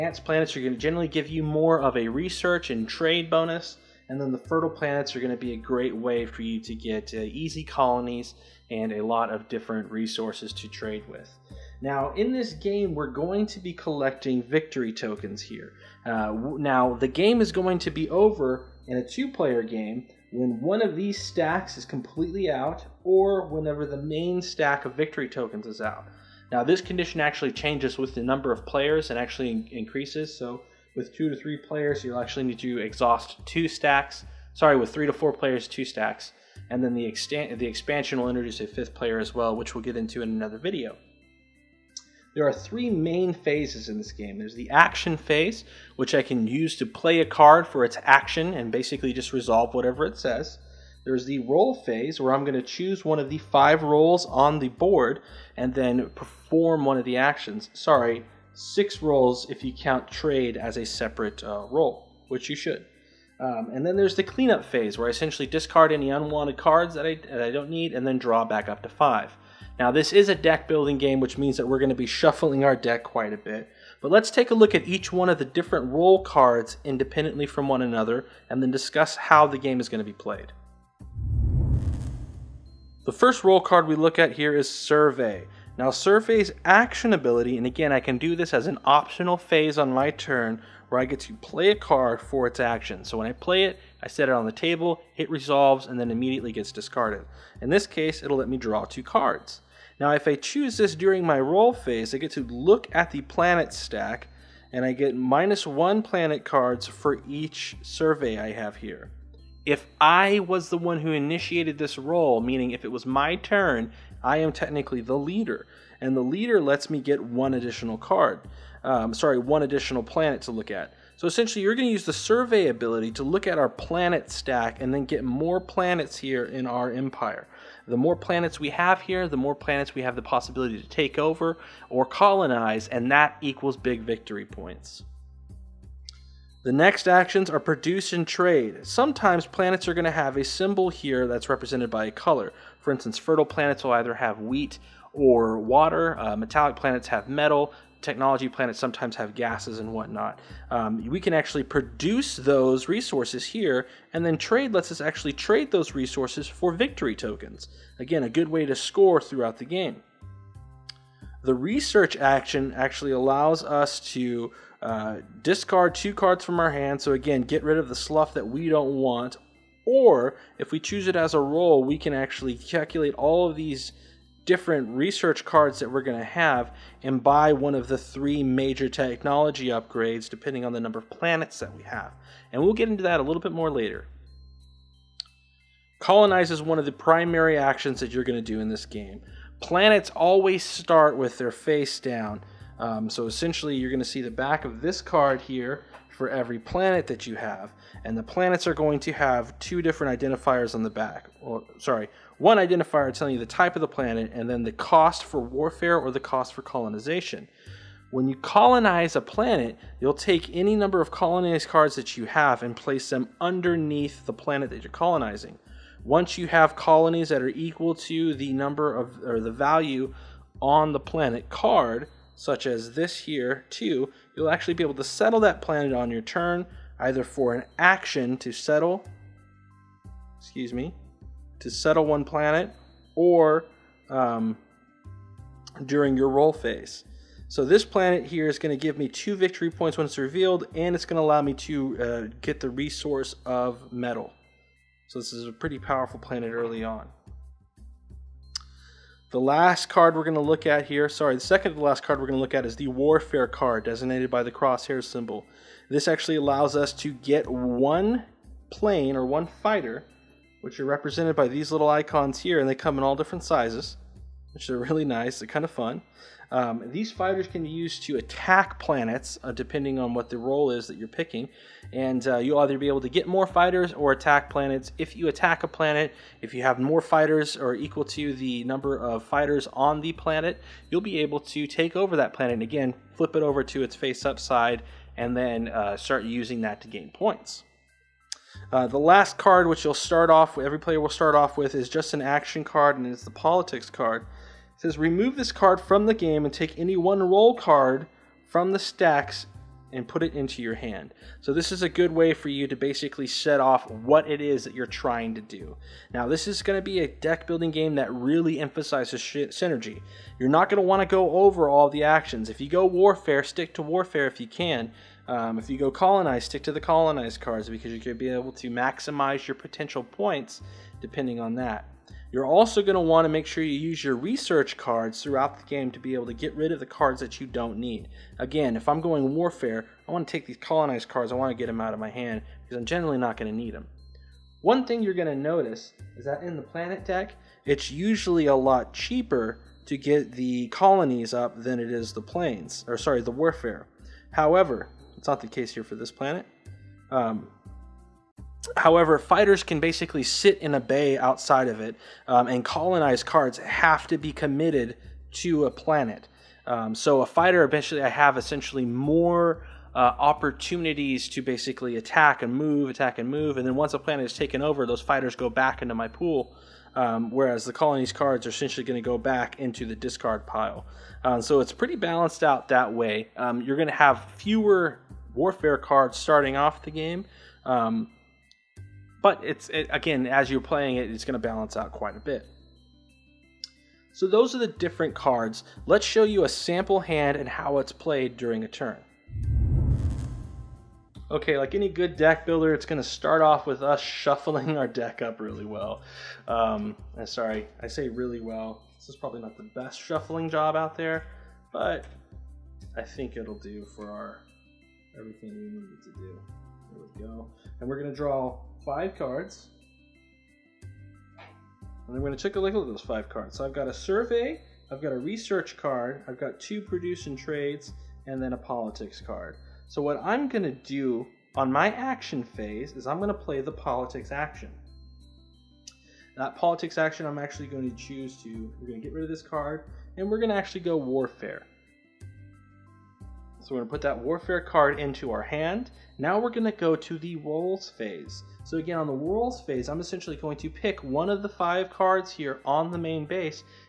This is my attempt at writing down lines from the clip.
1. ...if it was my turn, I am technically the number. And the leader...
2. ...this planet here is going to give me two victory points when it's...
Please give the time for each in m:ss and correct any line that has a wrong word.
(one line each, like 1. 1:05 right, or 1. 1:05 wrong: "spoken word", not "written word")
1. 1:52 wrong: "leader", not "number"
2. 3:57 right.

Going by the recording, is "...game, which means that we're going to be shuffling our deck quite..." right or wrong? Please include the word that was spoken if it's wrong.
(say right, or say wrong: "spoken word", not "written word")
right.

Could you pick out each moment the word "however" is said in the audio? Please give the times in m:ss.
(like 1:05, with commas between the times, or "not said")
5:44, 5:48.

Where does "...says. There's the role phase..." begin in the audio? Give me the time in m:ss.
0:50.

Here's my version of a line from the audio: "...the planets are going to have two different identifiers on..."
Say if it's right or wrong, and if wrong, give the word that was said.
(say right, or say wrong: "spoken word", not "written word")
right.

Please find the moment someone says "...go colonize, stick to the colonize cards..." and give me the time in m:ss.
5:15.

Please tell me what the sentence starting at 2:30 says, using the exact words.
Um, we can actually produce those resources here, and then trade lets us actually trade those resources for victory tokens.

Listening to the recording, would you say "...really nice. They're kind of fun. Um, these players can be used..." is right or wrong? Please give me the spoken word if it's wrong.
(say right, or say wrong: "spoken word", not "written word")
wrong: "fighters", not "players".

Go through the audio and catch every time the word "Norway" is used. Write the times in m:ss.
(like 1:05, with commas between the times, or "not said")
not said.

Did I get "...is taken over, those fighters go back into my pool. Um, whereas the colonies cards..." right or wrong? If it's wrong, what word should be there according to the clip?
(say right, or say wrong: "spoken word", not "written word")
right.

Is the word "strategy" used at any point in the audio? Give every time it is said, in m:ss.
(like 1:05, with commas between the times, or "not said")
not said.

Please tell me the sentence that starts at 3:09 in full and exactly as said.
Planets always start with their face down.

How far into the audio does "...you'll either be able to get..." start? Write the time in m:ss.
4:32.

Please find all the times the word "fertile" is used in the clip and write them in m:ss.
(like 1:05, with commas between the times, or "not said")
0:04, 2:23.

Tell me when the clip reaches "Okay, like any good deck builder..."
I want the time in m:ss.
6:31.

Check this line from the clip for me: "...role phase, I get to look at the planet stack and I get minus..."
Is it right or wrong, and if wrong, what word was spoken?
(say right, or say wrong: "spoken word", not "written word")
right.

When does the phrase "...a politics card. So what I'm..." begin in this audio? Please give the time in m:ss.
6:58.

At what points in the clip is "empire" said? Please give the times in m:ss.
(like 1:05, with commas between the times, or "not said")
2:06.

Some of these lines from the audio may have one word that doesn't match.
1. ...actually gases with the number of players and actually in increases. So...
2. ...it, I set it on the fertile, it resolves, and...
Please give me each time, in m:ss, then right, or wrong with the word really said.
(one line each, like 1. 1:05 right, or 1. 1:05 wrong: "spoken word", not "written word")
1. 0:27 wrong: "changes", not "gases"
2. 1:33 wrong: "table", not "fertile".